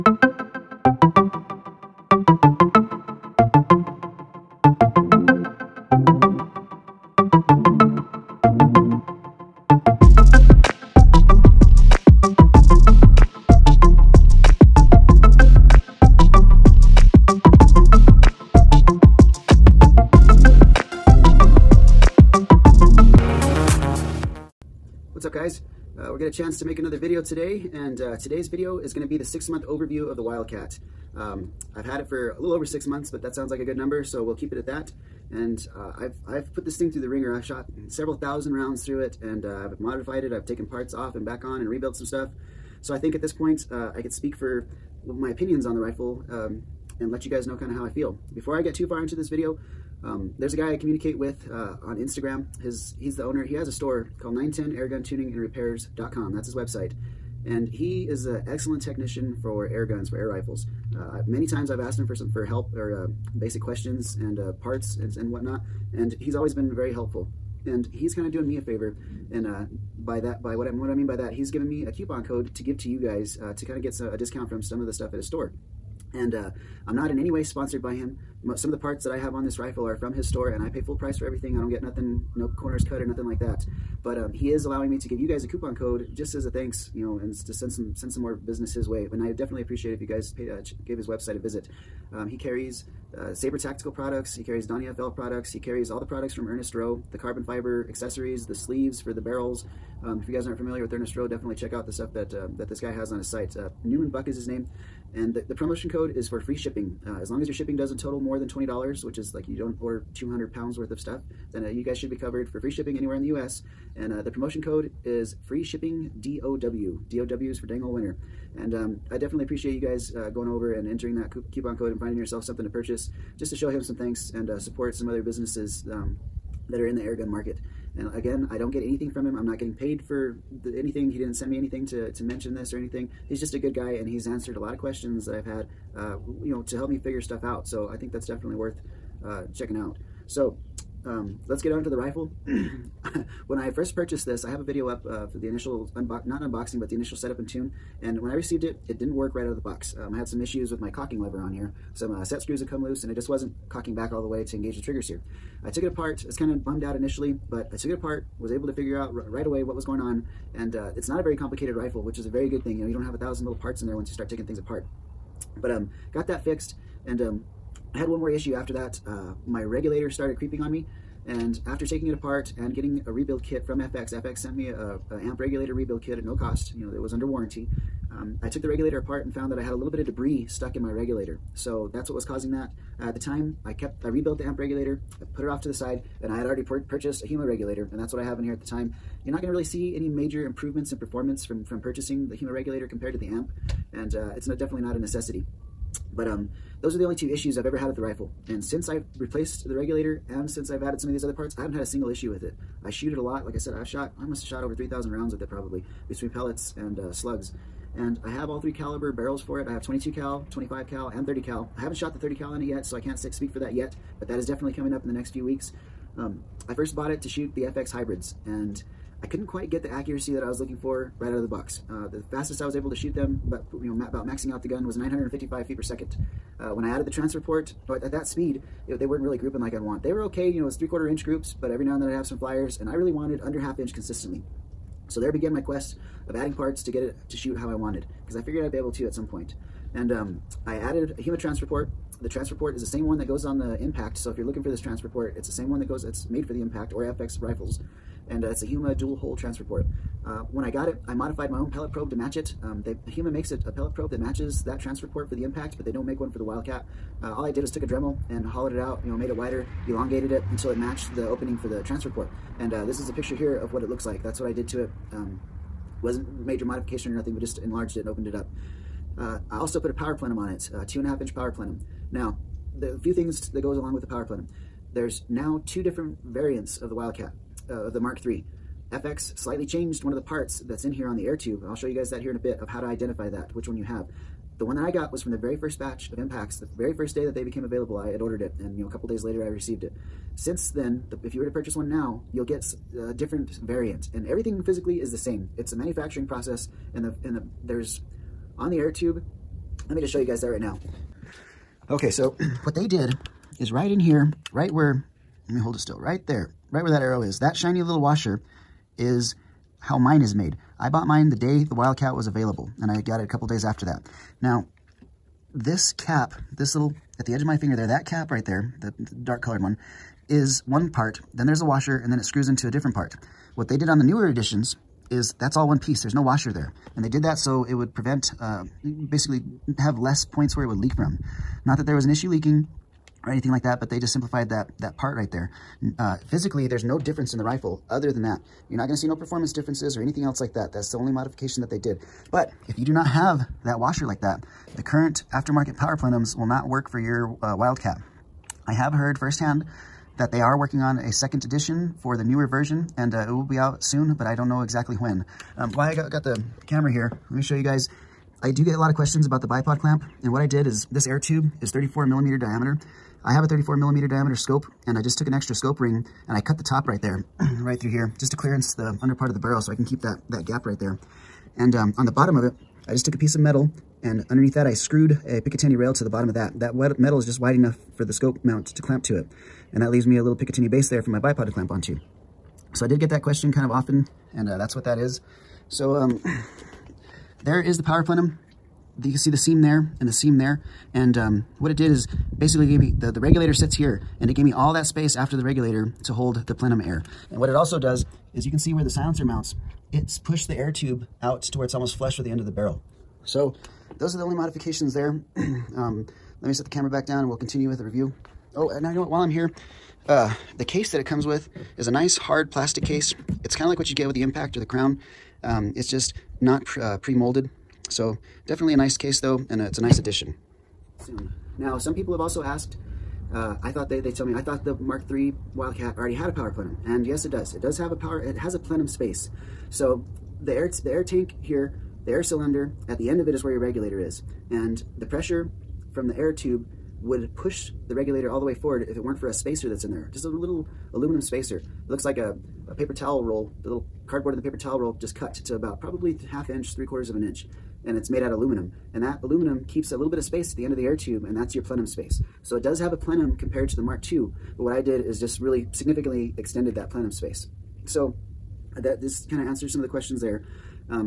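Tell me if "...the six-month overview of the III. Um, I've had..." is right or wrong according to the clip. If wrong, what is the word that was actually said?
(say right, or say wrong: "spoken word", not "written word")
wrong: "Wildcat", not "III".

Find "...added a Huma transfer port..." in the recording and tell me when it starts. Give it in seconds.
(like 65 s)
240 s.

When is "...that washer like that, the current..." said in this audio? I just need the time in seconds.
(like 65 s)
343 s.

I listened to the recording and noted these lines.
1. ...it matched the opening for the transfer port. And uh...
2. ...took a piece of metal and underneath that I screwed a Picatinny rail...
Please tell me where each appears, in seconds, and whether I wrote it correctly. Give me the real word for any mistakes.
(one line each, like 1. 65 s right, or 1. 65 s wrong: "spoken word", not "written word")
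1. 260 s right
2. 373 s right.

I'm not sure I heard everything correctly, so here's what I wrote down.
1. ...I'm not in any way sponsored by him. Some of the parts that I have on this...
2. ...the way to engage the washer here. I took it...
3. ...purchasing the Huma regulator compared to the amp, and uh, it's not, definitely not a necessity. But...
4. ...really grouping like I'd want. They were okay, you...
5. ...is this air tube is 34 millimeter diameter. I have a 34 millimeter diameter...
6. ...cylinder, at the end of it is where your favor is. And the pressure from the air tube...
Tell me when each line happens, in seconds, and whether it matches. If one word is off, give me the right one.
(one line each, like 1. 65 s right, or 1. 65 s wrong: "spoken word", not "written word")
1. 76 s right
2. 154 s wrong: "trigger", not "washer"
3. 191 s right
4. 229 s right
5. 360 s right
6. 432 s wrong: "regulator", not "favor".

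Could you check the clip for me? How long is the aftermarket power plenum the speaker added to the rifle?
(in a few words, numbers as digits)
2.5 inches.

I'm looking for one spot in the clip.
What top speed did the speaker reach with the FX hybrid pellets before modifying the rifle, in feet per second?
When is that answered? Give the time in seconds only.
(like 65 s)
224 s.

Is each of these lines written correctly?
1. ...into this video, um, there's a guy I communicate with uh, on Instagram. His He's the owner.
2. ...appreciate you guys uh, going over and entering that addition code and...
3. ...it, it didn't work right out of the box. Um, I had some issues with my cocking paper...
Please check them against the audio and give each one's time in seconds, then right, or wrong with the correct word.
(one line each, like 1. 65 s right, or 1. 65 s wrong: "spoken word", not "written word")
1. 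49 s right
2. 119 s wrong: "coupon", not "addition"
3. 148 s wrong: "lever", not "paper".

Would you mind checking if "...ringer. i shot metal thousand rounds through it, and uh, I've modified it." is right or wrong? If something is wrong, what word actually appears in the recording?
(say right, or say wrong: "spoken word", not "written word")
wrong: "several", not "metal".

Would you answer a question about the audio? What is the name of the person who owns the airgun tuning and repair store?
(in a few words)
Newman Buck.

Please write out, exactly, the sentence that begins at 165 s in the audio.
But um, got that fixed, and um, I had one more issue after that.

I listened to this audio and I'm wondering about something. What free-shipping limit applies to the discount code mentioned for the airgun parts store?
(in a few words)
$20.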